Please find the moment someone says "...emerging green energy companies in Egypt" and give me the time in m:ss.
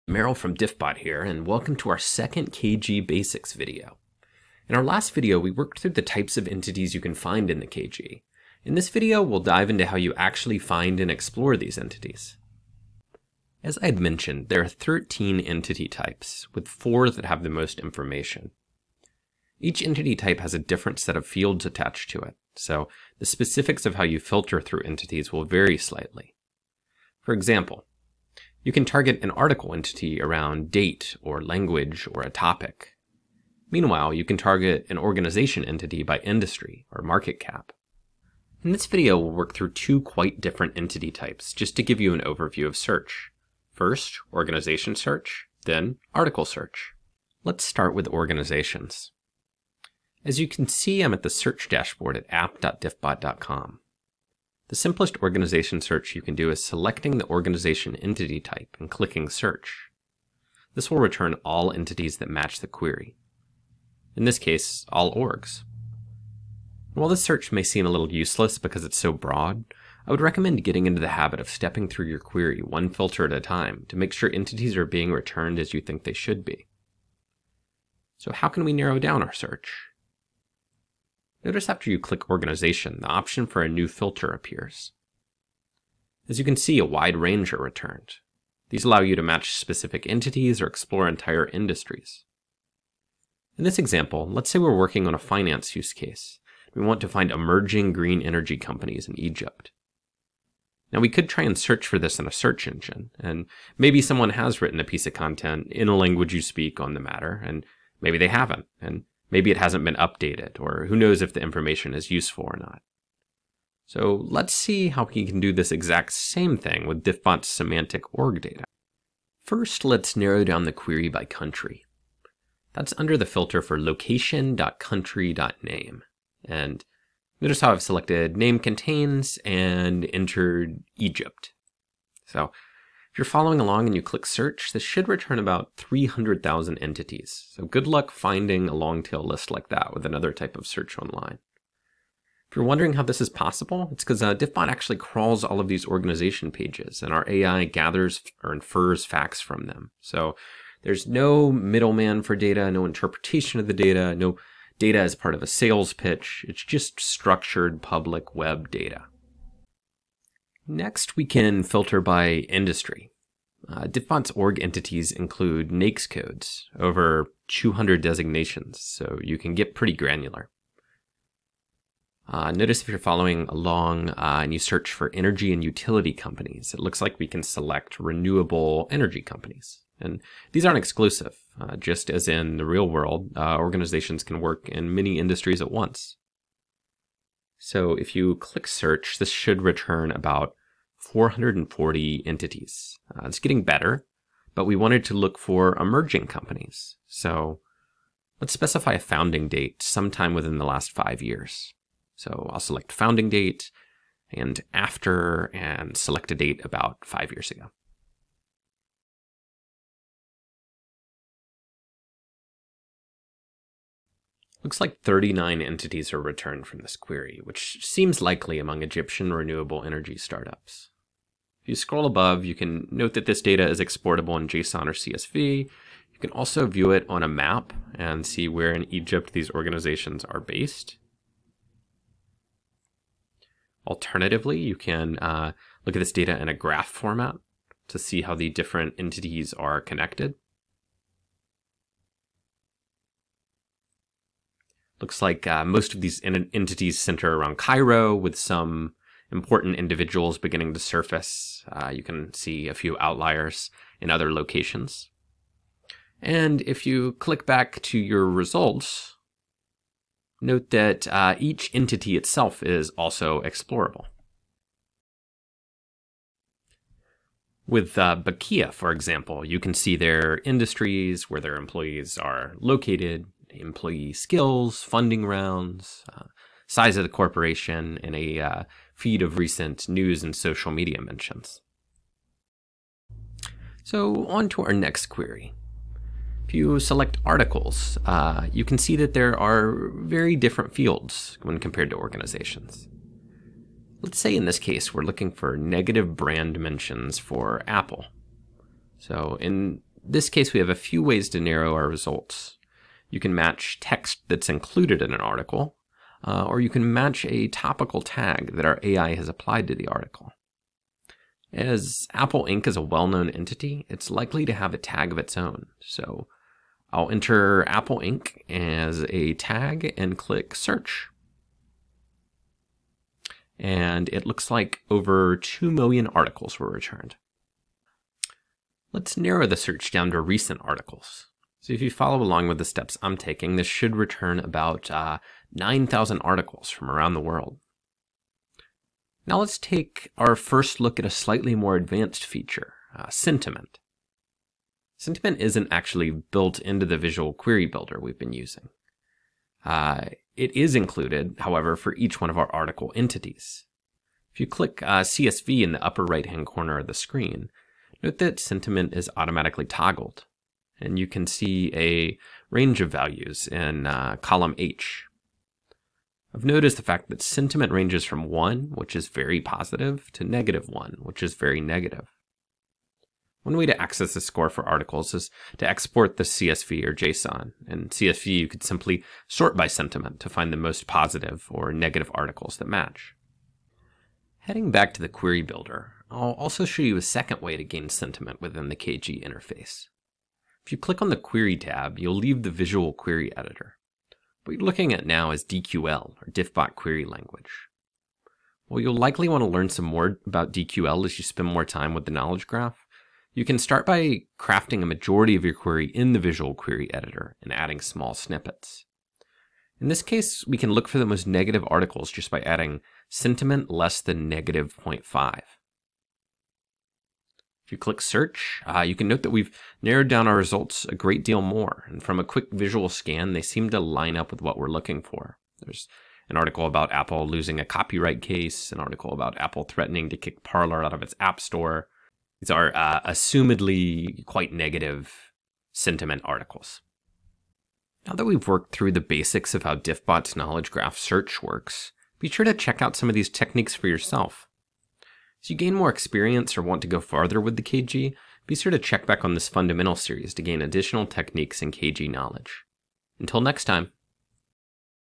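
1:37.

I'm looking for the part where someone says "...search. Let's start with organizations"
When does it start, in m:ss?
0:46.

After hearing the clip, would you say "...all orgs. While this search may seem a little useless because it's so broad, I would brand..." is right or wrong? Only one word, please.
wrong.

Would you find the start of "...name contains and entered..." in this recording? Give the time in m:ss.
2:08.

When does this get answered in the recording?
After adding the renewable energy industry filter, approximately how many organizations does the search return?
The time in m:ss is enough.
3:10.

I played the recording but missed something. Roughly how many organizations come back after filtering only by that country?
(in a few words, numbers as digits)
300,000.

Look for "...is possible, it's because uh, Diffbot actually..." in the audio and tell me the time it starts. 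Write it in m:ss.
2:23.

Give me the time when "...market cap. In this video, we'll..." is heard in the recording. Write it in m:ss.
0:37.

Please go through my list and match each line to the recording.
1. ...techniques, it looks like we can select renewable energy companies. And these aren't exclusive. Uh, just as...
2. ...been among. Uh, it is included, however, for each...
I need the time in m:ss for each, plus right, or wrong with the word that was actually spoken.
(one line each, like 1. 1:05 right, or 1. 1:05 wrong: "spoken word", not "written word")
1. 2:56 wrong: "companies", not "techniques"
2. 5:48 wrong: "using", not "among".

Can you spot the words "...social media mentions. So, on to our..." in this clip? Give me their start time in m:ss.
4:40.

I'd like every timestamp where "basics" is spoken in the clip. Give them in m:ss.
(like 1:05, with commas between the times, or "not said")
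0:03, 7:18.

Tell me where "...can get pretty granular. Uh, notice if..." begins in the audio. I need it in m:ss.
2:49.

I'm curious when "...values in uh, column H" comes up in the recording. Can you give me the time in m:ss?
6:02.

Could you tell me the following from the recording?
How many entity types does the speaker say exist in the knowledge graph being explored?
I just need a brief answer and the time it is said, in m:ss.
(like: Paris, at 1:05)
13, at 0:14.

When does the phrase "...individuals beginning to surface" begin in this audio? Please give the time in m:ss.
4:09.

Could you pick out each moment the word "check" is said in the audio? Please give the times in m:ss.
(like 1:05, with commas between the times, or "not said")
7:22, 7:28.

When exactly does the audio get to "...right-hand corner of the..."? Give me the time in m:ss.
5:56.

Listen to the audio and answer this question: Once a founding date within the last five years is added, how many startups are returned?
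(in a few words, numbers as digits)
39.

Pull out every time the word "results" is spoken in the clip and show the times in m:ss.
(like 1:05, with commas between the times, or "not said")
4:18, 5:01, 7:00.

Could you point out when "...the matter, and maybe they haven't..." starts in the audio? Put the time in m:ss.
1:46.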